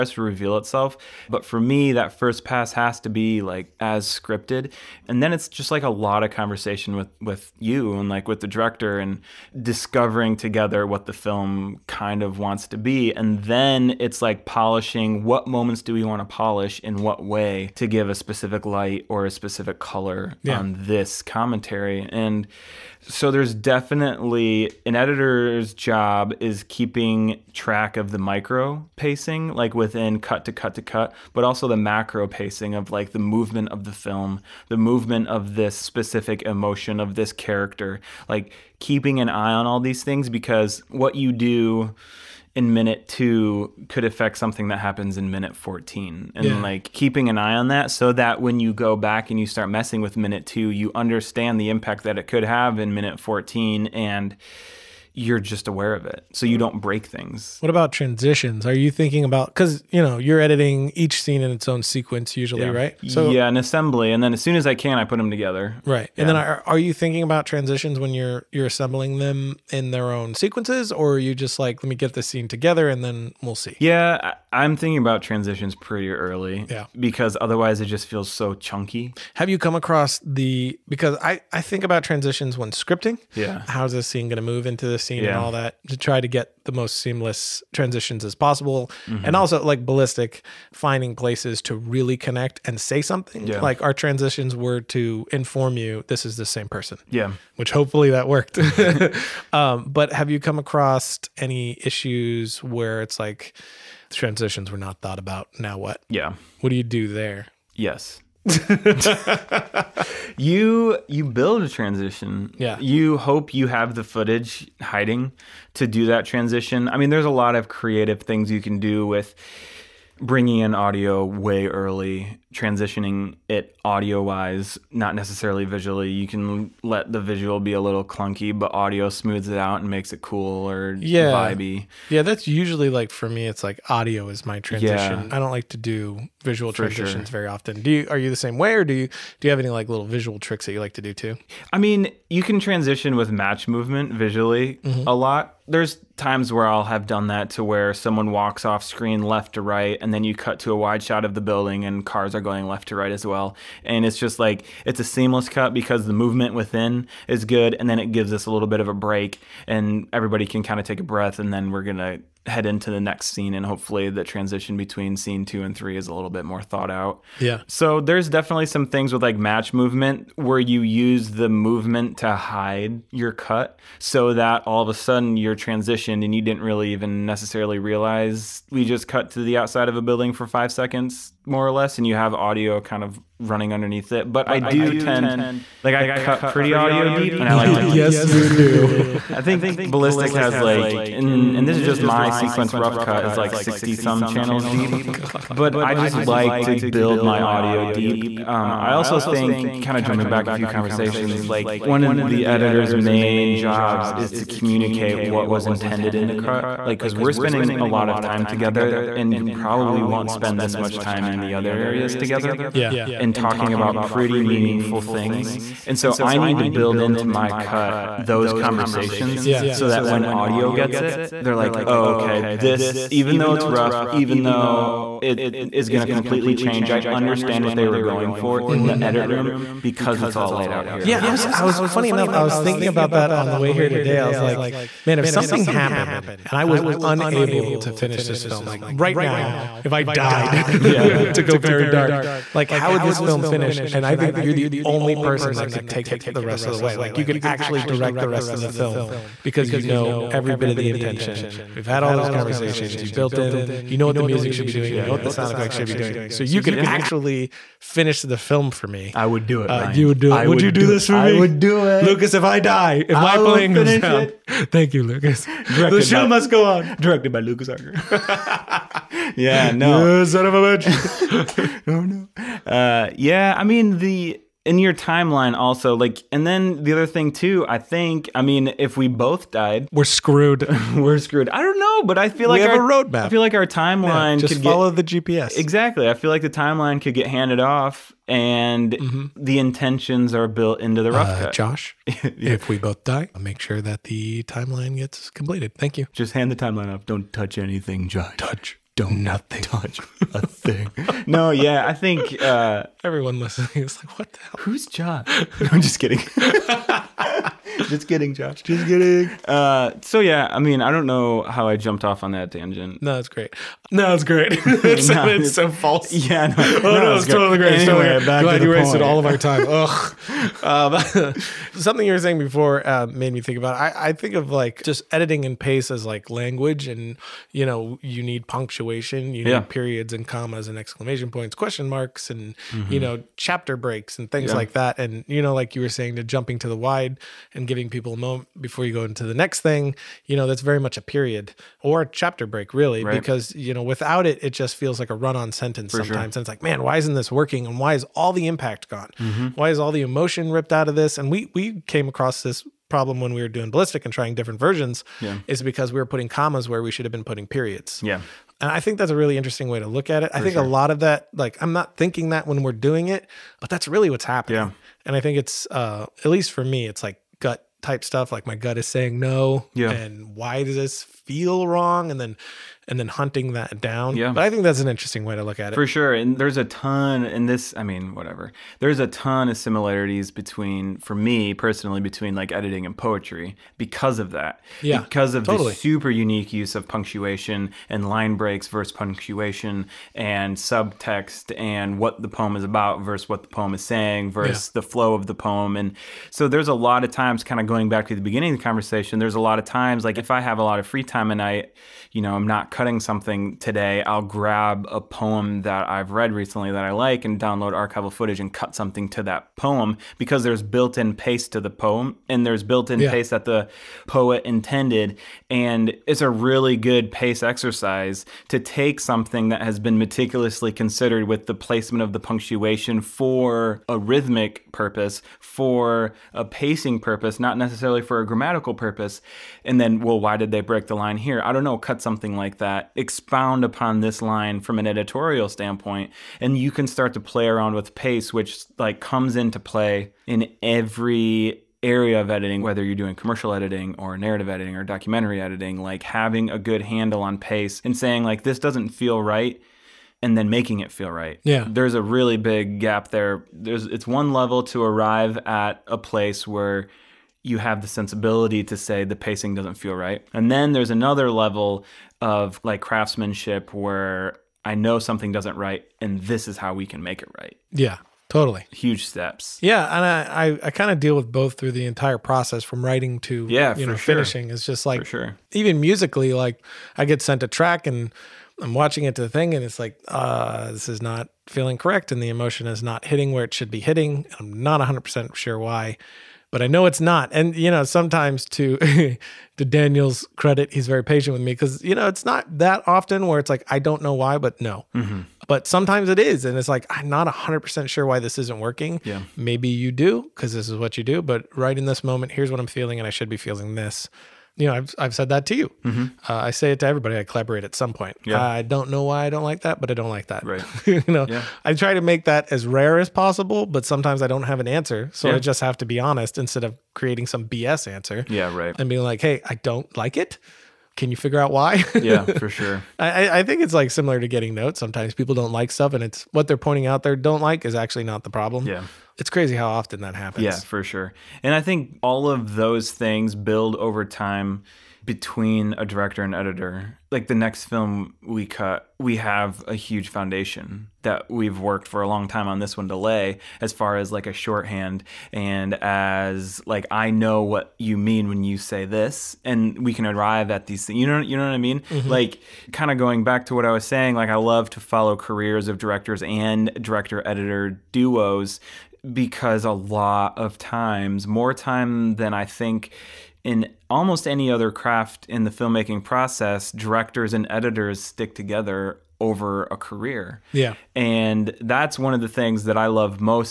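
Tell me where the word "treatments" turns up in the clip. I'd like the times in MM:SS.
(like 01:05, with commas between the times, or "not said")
not said.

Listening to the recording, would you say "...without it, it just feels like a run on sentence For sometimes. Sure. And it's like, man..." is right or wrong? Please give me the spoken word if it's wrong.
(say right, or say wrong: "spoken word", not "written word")
right.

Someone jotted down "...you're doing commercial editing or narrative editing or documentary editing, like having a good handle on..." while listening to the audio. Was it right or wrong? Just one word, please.
right.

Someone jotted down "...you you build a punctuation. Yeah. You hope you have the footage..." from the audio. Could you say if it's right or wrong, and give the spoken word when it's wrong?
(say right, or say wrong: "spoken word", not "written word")
wrong: "transition", not "punctuation".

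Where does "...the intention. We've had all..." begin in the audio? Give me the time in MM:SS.
04:10.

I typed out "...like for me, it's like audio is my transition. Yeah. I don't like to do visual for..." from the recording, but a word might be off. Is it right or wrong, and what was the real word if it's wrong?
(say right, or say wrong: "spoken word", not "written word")
right.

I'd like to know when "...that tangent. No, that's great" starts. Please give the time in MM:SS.
05:12.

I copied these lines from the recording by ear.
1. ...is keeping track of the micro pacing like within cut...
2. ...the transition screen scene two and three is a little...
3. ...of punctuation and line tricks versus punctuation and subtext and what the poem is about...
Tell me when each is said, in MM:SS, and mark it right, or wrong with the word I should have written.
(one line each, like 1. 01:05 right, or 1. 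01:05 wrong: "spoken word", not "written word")
1. 00:26 right
2. 02:44 wrong: "between", not "screen"
3. 06:26 wrong: "breaks", not "tricks".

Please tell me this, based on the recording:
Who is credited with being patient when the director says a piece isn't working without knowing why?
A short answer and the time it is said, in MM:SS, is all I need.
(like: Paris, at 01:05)
Daniel, at 08:09.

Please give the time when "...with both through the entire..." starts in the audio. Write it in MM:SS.
07:51.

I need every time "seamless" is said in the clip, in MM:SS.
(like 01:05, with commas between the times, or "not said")
01:26, 02:35.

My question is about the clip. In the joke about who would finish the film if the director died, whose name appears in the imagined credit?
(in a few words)
Lucas Harger.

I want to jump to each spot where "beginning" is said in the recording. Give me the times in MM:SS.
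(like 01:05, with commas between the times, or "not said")
06:38.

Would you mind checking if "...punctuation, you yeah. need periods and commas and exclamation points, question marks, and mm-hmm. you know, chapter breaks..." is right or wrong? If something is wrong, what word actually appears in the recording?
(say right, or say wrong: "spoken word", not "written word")
right.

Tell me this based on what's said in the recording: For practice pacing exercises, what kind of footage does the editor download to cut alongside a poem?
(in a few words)
Archival footage.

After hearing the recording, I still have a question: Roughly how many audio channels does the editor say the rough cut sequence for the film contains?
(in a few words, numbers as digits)
sixty some.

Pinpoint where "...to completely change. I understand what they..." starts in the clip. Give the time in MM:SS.
03:46.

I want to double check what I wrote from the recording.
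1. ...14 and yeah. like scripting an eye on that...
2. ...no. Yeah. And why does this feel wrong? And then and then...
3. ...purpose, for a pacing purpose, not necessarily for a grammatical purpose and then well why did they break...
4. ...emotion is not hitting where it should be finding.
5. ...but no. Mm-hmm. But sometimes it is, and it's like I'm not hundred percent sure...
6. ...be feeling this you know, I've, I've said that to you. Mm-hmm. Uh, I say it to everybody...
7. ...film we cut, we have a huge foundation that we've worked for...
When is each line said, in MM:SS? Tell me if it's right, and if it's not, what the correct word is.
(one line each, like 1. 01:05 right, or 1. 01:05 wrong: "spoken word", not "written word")
1. 00:45 wrong: "keeping", not "scripting"
2. 06:09 right
3. 07:04 right
4. 08:02 wrong: "hitting", not "finding"
5. 08:14 right
6. 08:23 right
7. 08:57 right.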